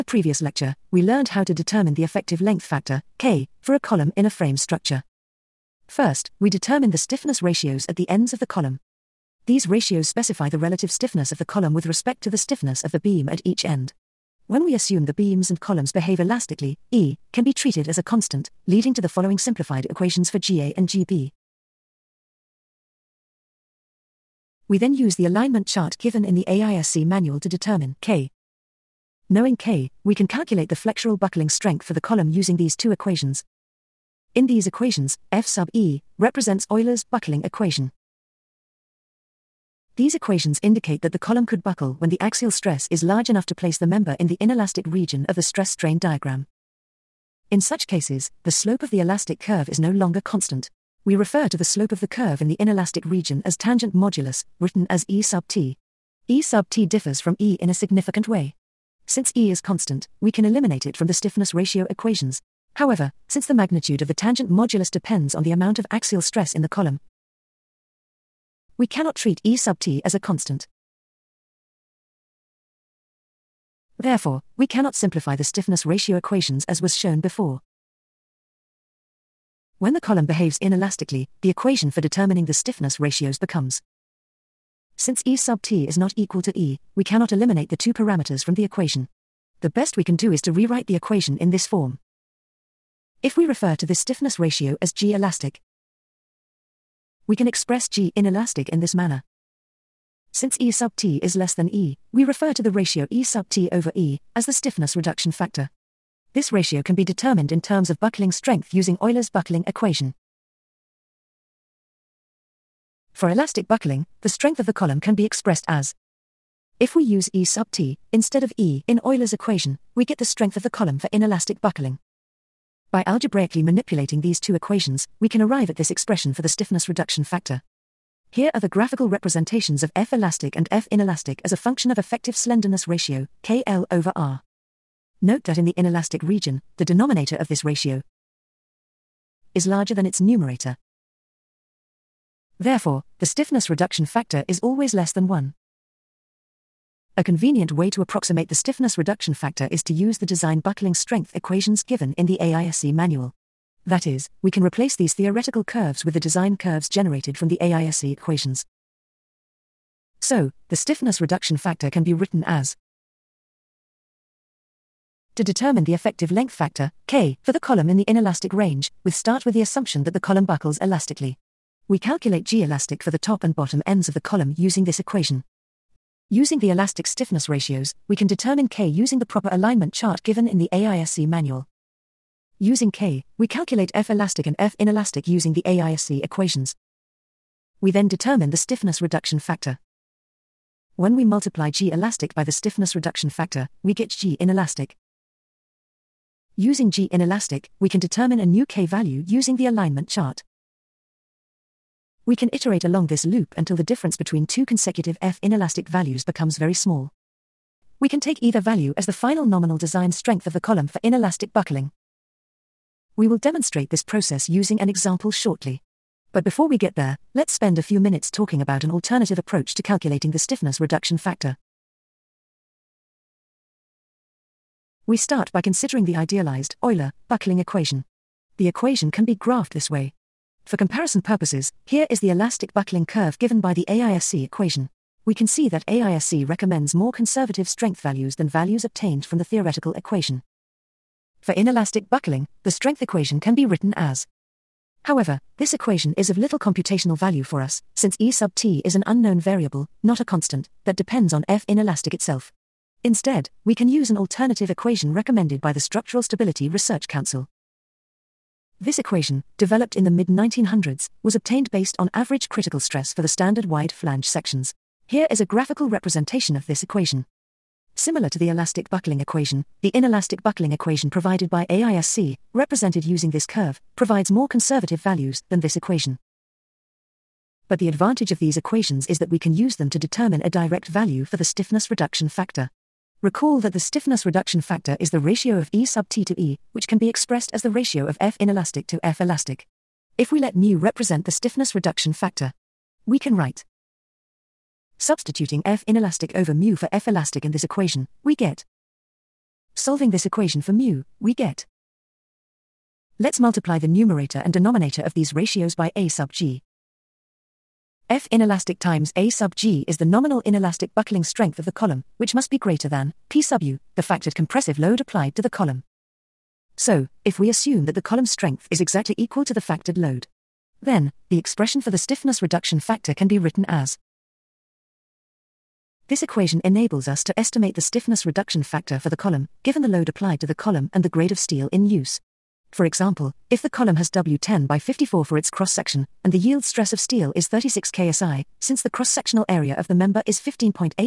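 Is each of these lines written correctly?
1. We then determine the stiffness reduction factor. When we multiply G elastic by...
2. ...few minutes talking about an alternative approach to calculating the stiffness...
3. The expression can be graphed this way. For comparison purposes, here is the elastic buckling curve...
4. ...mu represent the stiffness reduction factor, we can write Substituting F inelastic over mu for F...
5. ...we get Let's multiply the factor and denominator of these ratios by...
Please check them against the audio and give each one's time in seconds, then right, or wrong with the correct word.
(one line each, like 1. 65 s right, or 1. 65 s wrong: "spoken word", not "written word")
1. 187 s right
2. 217 s right
3. 228 s wrong: "equation", not "expression"
4. 290 s right
5. 301 s wrong: "numerator", not "factor".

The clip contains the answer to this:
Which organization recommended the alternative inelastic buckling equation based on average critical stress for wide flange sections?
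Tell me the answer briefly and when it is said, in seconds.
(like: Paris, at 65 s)
Structural Stability Research Council, at 255 s.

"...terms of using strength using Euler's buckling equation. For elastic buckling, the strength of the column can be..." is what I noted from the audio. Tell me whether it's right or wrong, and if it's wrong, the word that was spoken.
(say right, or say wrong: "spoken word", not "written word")
wrong: "buckling", not "using".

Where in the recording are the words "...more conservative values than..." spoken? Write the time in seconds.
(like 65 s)
274 s.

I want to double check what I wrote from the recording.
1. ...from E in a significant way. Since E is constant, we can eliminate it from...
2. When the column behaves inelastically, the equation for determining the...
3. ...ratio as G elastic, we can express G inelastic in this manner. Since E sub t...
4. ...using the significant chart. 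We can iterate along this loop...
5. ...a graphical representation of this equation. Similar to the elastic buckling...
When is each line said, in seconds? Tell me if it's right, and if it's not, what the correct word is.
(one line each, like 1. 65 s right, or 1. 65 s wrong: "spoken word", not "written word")
1. 57 s right
2. 79 s right
3. 94 s right
4. 199 s wrong: "alignment", not "significant"
5. 265 s right.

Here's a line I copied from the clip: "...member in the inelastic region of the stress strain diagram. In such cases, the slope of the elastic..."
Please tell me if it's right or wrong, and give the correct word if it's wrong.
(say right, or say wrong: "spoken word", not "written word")
right.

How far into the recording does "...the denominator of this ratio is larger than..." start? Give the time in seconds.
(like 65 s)
136 s.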